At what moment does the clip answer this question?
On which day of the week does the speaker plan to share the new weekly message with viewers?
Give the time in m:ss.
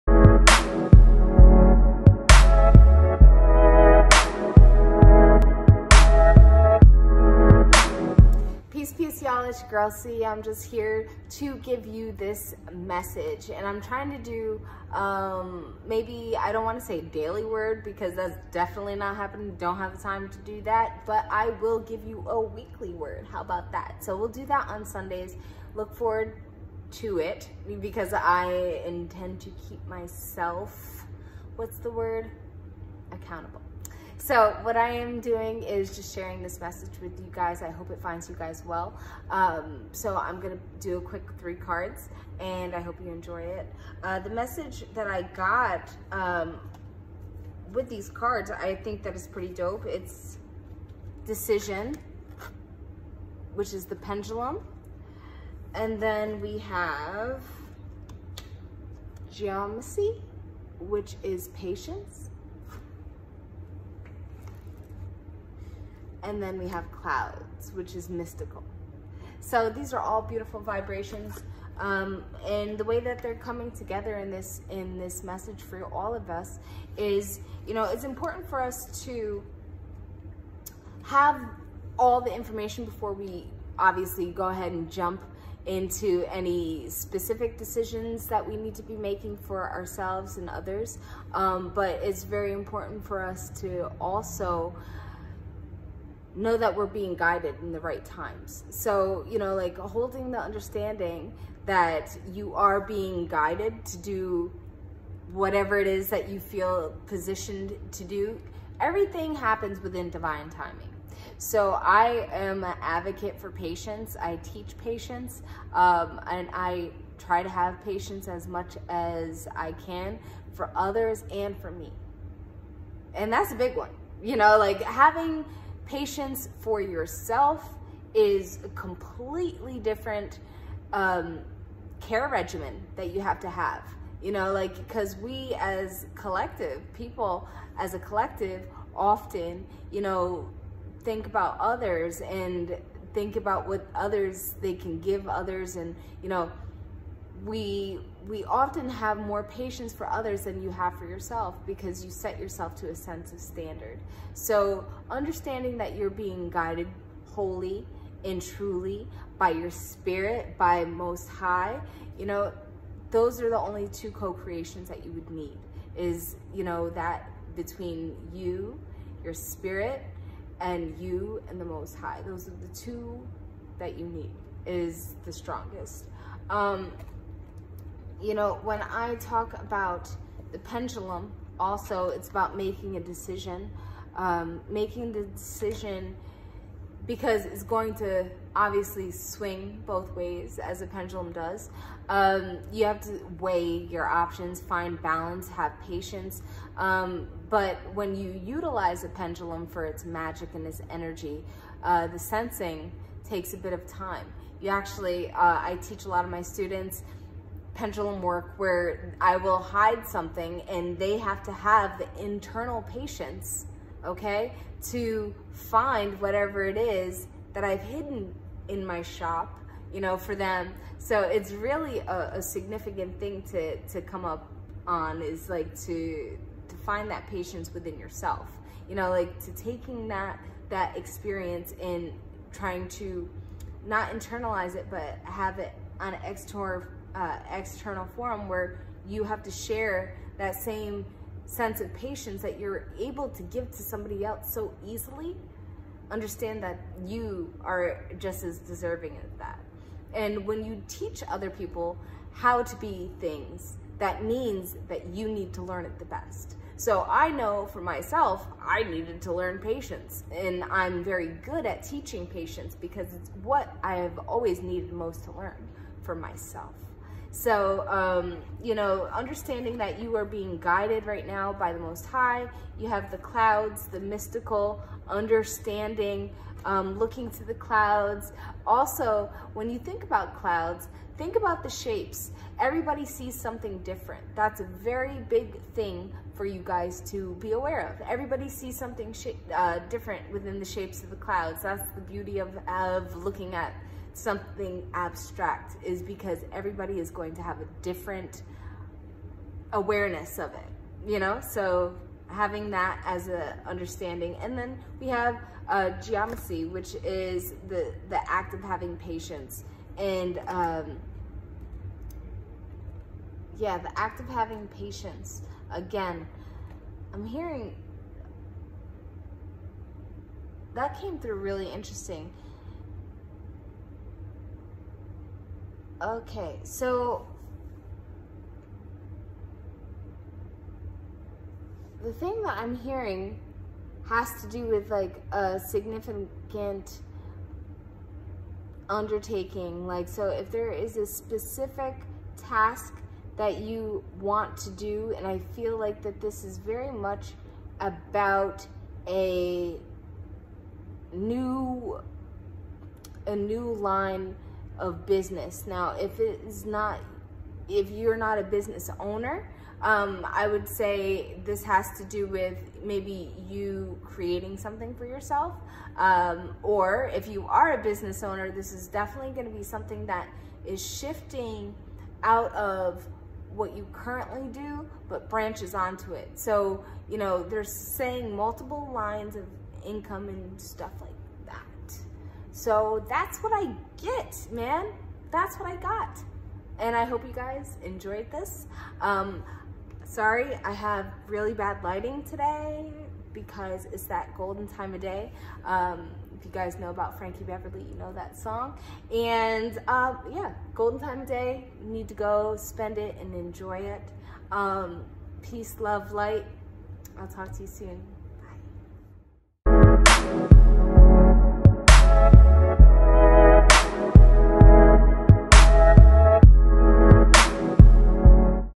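0:24.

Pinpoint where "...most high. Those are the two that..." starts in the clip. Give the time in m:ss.
2:51.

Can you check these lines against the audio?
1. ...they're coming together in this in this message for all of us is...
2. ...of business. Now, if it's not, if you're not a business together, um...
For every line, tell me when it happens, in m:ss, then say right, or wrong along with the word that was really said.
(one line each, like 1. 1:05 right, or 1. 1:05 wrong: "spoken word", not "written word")
1. 1:13 right
2. 5:54 wrong: "owner", not "together".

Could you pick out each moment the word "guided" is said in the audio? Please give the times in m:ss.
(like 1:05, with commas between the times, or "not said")
1:37, 1:43, 2:36, 4:30.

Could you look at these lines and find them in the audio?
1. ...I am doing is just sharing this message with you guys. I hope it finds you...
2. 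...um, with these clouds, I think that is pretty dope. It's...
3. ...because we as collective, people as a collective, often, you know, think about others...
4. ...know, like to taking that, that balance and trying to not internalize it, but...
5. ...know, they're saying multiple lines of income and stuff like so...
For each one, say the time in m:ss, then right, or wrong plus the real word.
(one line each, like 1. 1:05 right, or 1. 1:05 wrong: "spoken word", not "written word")
1. 0:34 right
2. 0:46 wrong: "cards", not "clouds"
3. 2:14 right
4. 3:48 wrong: "experience", not "balance"
5. 6:17 right.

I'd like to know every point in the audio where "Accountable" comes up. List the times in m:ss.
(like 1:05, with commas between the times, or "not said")
0:33.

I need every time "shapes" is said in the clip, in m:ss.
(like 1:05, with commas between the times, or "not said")
4:41, 4:50.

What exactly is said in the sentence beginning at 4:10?
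And when you teach other people how to be things, that means that you need to learn it the best.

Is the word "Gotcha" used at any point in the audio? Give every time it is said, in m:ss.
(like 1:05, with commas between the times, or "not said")
not said.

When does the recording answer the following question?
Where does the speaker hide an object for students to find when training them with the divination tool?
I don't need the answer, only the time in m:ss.
3:38.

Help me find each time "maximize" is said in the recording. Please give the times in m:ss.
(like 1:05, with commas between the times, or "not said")
not said.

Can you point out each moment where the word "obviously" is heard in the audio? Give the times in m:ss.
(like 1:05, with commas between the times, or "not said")
1:23, 3:08.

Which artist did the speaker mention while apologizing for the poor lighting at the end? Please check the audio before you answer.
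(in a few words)
Frankie Beverly.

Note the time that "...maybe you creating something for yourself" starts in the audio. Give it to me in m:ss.
6:02.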